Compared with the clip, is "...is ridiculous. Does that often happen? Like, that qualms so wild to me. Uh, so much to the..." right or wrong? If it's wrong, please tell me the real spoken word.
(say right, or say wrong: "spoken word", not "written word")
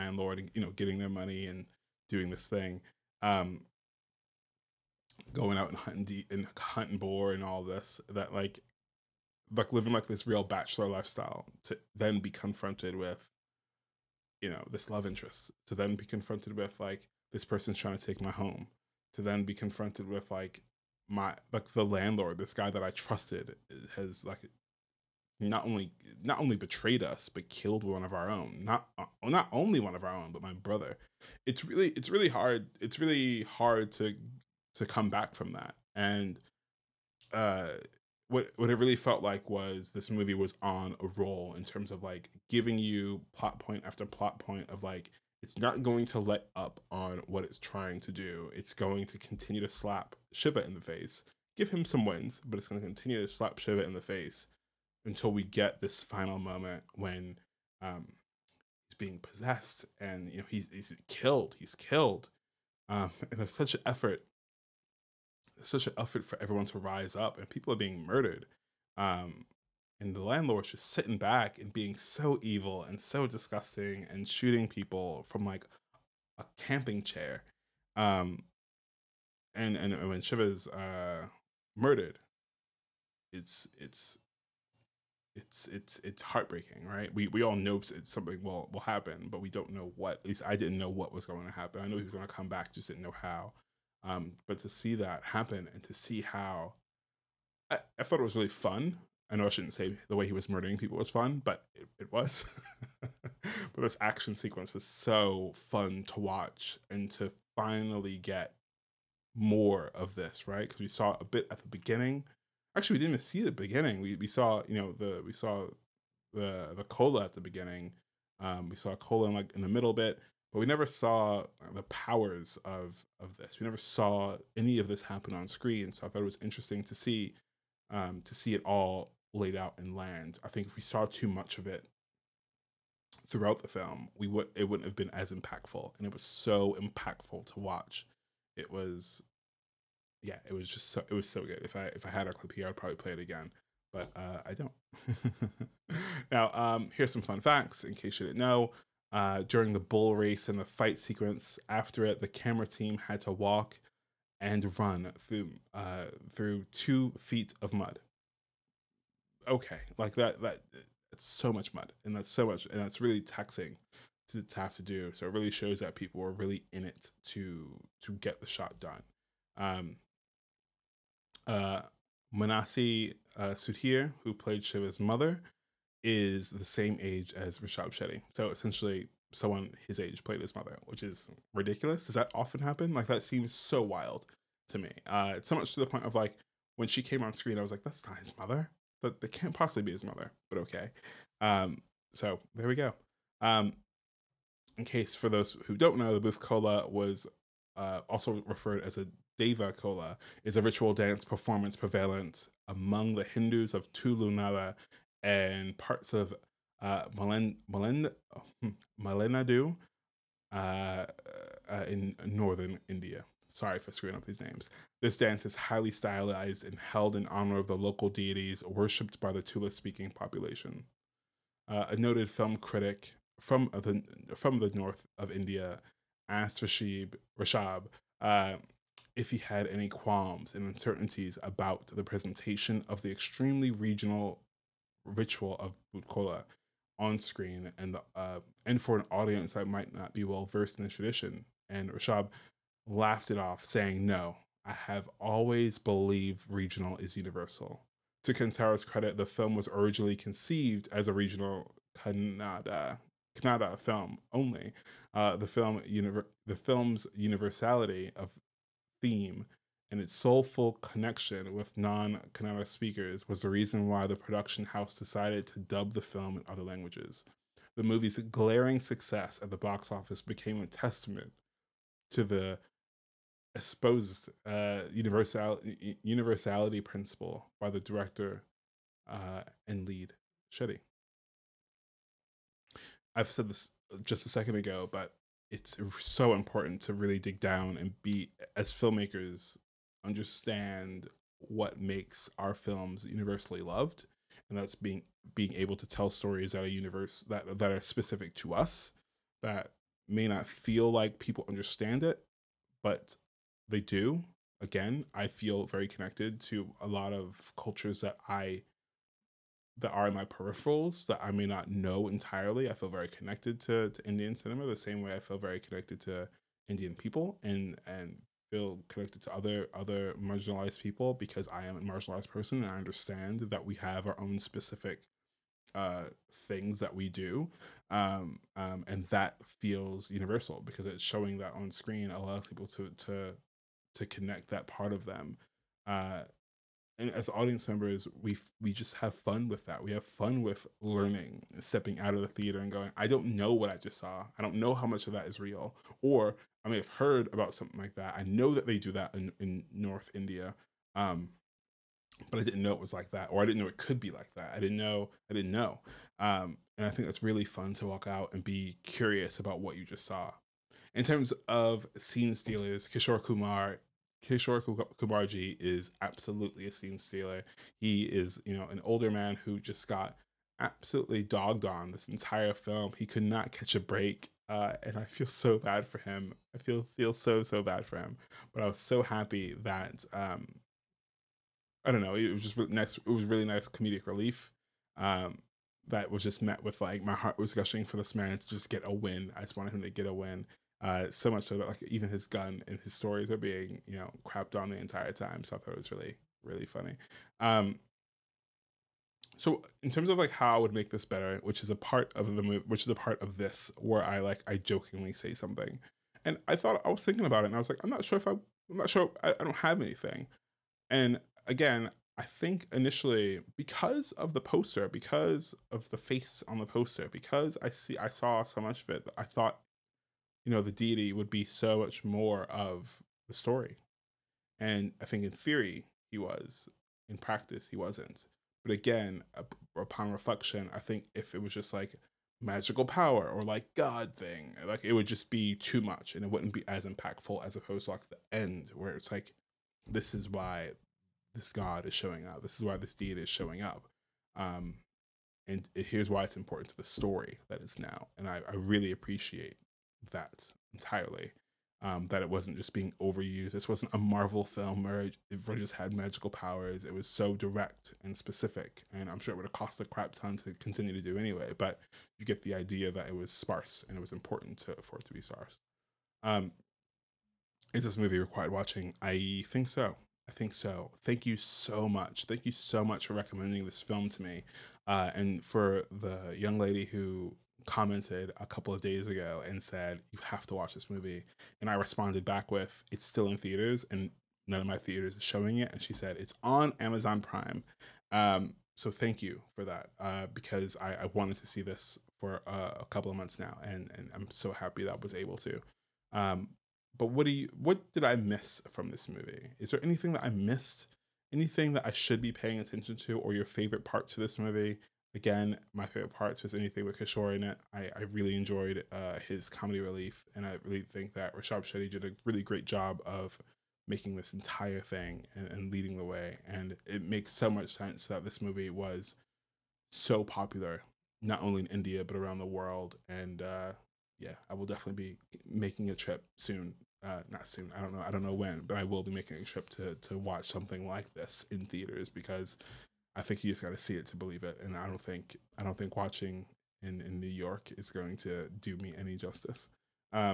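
wrong: "seems", not "qualms".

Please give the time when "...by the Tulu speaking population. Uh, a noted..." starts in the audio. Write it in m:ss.
3:39.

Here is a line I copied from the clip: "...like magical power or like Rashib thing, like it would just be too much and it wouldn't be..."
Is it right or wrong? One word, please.
wrong.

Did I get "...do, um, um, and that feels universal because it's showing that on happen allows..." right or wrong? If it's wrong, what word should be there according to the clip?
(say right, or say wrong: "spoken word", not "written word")
wrong: "screen", not "happen".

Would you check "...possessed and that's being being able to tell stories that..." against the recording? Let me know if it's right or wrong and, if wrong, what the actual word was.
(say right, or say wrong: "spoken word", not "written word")
wrong: "loved", not "possessed".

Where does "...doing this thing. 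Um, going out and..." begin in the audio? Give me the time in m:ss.
0:02.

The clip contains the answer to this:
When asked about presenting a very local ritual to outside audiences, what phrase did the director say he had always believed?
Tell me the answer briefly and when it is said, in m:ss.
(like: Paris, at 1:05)
Regional is universal, at 4:06.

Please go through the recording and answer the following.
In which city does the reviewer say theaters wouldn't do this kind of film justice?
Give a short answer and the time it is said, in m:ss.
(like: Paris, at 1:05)
New York, at 8:57.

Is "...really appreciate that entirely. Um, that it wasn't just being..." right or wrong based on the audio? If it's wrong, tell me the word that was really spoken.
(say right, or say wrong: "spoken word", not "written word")
right.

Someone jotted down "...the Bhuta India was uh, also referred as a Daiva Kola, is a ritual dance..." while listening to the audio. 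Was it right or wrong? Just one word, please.
wrong.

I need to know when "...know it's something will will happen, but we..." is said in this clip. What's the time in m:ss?
1:27.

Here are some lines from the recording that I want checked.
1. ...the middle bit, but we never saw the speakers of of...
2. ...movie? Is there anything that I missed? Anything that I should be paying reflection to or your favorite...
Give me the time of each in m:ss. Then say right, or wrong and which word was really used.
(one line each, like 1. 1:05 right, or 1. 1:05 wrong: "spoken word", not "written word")
1. 1:59 wrong: "powers", not "speakers"
2. 8:19 wrong: "attention", not "reflection".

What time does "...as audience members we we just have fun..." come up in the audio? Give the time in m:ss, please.
5:37.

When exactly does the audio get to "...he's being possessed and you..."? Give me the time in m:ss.
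0:58.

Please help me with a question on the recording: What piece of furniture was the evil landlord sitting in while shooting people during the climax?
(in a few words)
A camping chair.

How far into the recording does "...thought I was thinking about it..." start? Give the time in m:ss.
6:46.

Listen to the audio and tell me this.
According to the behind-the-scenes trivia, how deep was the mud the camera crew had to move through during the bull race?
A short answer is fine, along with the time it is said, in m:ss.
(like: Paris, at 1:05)
2 feet, at 2:36.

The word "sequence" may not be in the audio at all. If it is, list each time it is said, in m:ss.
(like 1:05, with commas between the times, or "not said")
1:44, 2:30.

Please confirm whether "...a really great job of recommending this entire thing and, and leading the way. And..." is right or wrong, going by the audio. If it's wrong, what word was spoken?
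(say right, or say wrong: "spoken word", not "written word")
wrong: "making", not "recommending".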